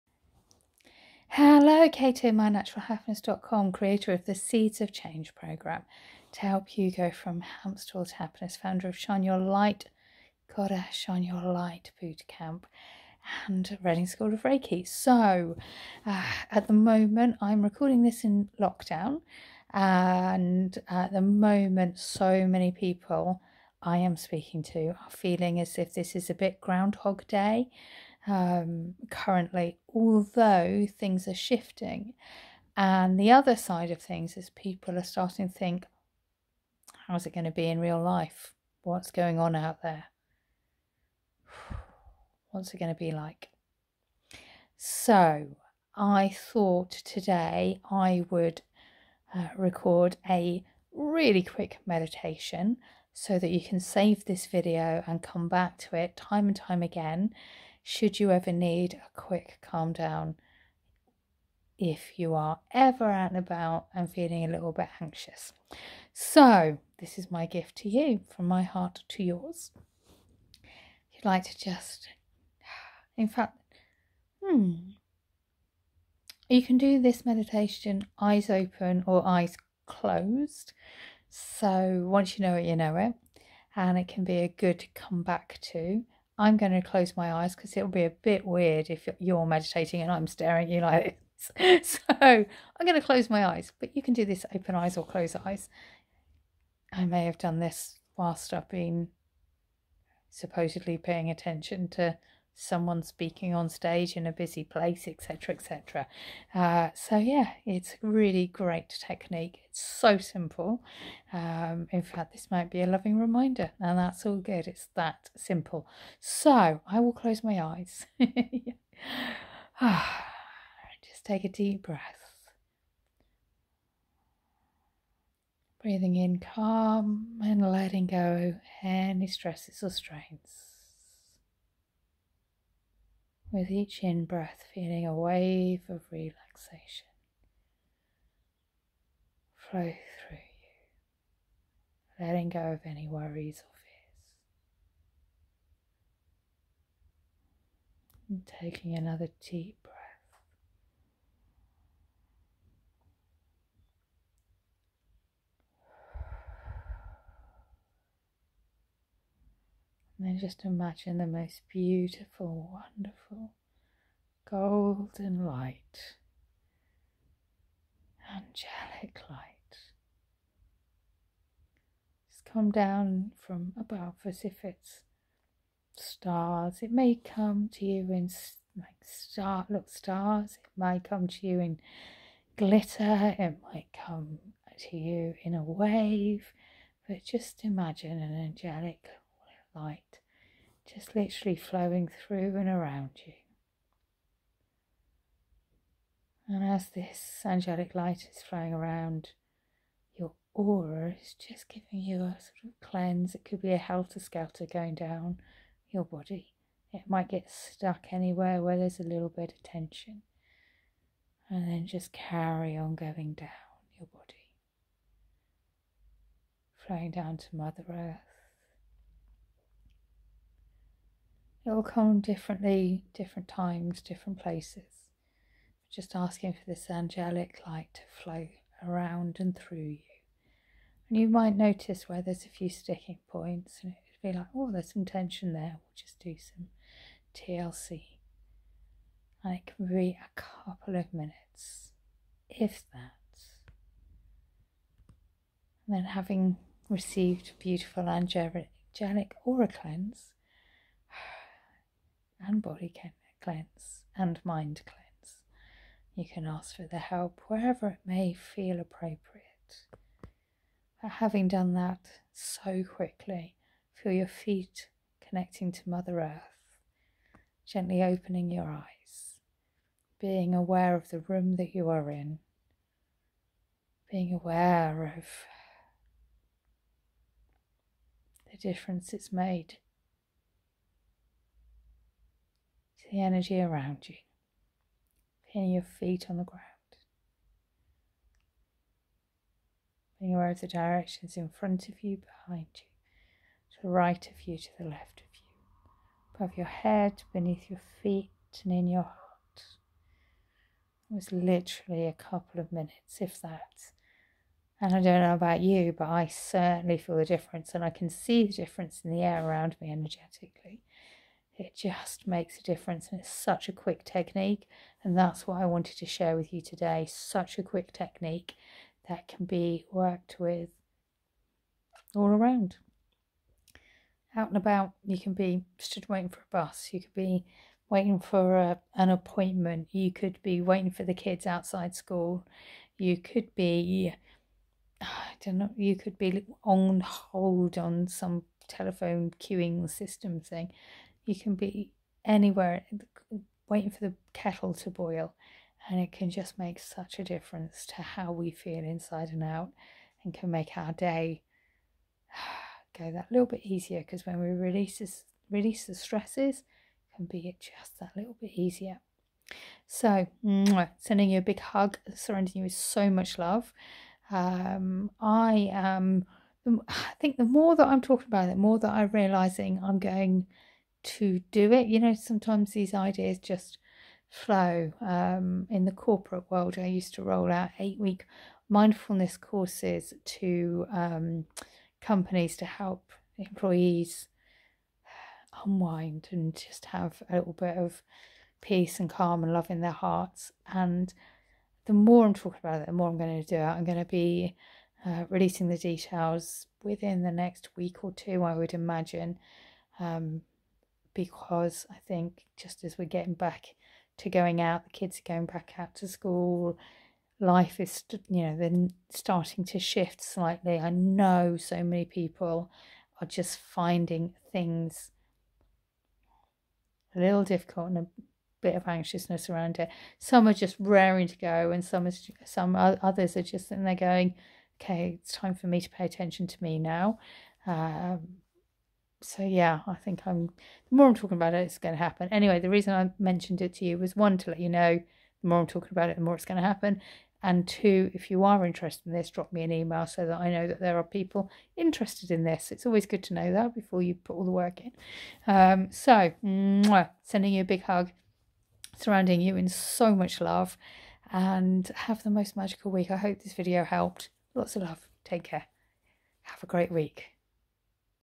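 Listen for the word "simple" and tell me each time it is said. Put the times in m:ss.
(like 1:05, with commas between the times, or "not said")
1:50, 1:55.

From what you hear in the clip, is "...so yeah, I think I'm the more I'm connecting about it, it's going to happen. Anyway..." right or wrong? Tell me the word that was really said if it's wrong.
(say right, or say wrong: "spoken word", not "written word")
wrong: "talking", not "connecting".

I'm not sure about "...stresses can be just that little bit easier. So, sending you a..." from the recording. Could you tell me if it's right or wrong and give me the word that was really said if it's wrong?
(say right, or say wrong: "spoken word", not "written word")
right.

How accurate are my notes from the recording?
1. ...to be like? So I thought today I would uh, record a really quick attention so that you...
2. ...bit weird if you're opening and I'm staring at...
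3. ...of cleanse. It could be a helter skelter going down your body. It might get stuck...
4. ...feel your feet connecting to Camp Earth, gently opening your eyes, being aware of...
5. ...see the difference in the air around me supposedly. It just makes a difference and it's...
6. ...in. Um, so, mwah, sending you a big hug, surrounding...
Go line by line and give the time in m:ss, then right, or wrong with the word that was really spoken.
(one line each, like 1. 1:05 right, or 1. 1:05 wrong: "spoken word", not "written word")
1. 0:42 wrong: "meditation", not "attention"
2. 1:28 wrong: "meditating", not "opening"
3. 3:22 right
4. 4:23 wrong: "Mother", not "Camp"
5. 5:08 wrong: "energetically", not "supposedly"
6. 7:24 right.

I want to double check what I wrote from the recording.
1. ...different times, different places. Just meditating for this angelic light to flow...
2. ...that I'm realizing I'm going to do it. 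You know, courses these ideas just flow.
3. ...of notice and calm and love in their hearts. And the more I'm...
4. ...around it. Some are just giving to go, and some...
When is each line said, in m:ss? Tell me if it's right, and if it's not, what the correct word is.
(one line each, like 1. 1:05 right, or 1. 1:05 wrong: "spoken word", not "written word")
1. 3:43 wrong: "asking", not "meditating"
2. 6:08 wrong: "sometimes", not "courses"
3. 6:27 wrong: "peace", not "notice"
4. 6:59 wrong: "raring", not "giving".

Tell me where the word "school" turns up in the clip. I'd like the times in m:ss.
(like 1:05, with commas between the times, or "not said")
0:14, 5:31, 6:46.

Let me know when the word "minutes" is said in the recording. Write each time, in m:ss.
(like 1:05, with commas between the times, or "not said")
4:01, 5:02.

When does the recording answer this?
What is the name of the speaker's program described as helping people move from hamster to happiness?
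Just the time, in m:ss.
0:04.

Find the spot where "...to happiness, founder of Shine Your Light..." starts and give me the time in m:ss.
0:08.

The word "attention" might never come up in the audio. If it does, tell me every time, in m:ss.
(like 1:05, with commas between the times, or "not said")
1:41, 7:06.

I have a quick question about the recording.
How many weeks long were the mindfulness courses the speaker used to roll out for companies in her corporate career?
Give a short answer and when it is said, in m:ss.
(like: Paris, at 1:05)
8 weeks, at 6:17.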